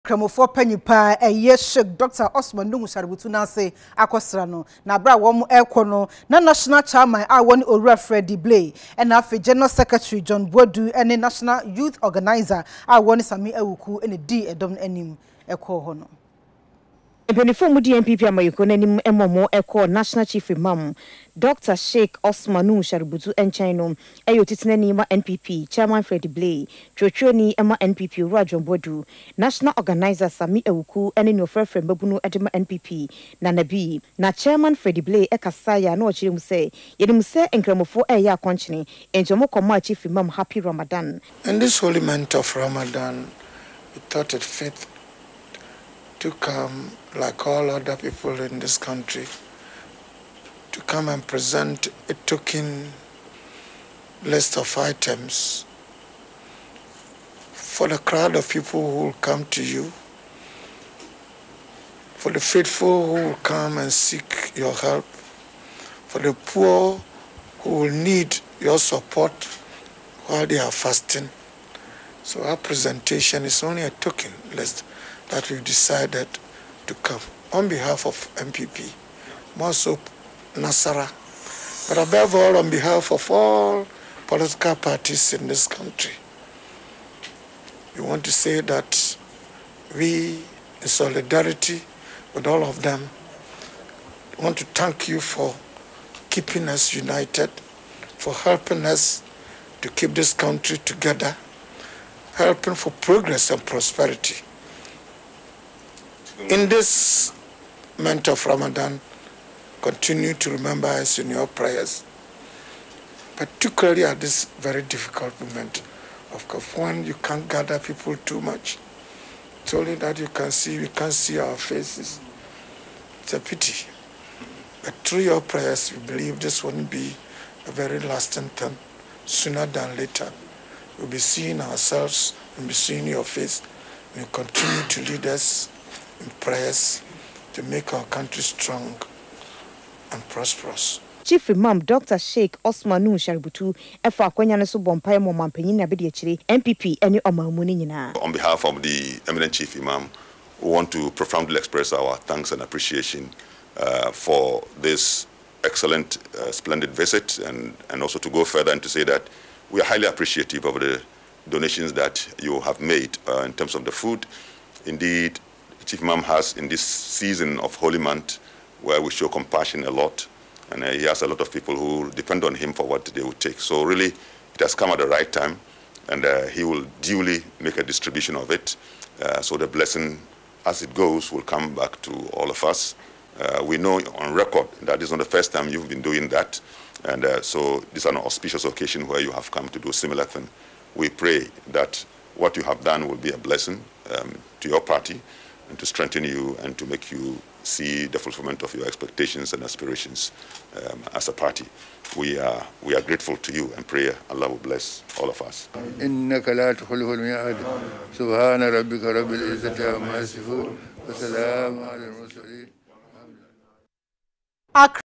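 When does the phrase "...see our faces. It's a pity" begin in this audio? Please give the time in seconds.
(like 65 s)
121 s.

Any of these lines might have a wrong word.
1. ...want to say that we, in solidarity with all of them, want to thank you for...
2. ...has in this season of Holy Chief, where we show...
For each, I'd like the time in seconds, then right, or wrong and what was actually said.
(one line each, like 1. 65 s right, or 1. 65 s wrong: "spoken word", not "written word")
1. 88 s right
2. 166 s wrong: "Month", not "Chief".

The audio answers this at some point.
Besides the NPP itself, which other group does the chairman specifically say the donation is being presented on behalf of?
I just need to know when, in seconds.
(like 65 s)
80 s.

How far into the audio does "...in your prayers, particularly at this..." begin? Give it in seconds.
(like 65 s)
111 s.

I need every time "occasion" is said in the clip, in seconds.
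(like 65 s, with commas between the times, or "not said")
188 s.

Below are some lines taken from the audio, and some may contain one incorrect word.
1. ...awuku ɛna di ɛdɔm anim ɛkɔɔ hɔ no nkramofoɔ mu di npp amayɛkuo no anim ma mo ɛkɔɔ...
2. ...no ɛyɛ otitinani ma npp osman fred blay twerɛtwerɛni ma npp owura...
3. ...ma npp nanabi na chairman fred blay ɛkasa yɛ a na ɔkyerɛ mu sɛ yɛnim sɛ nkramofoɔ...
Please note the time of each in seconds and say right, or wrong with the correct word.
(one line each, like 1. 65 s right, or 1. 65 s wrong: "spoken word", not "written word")
1. 13 s wrong: "mpanimfoɔ", not "nkramofoɔ"
2. 23 s wrong: "chairman", not "osman"
3. 32 s right.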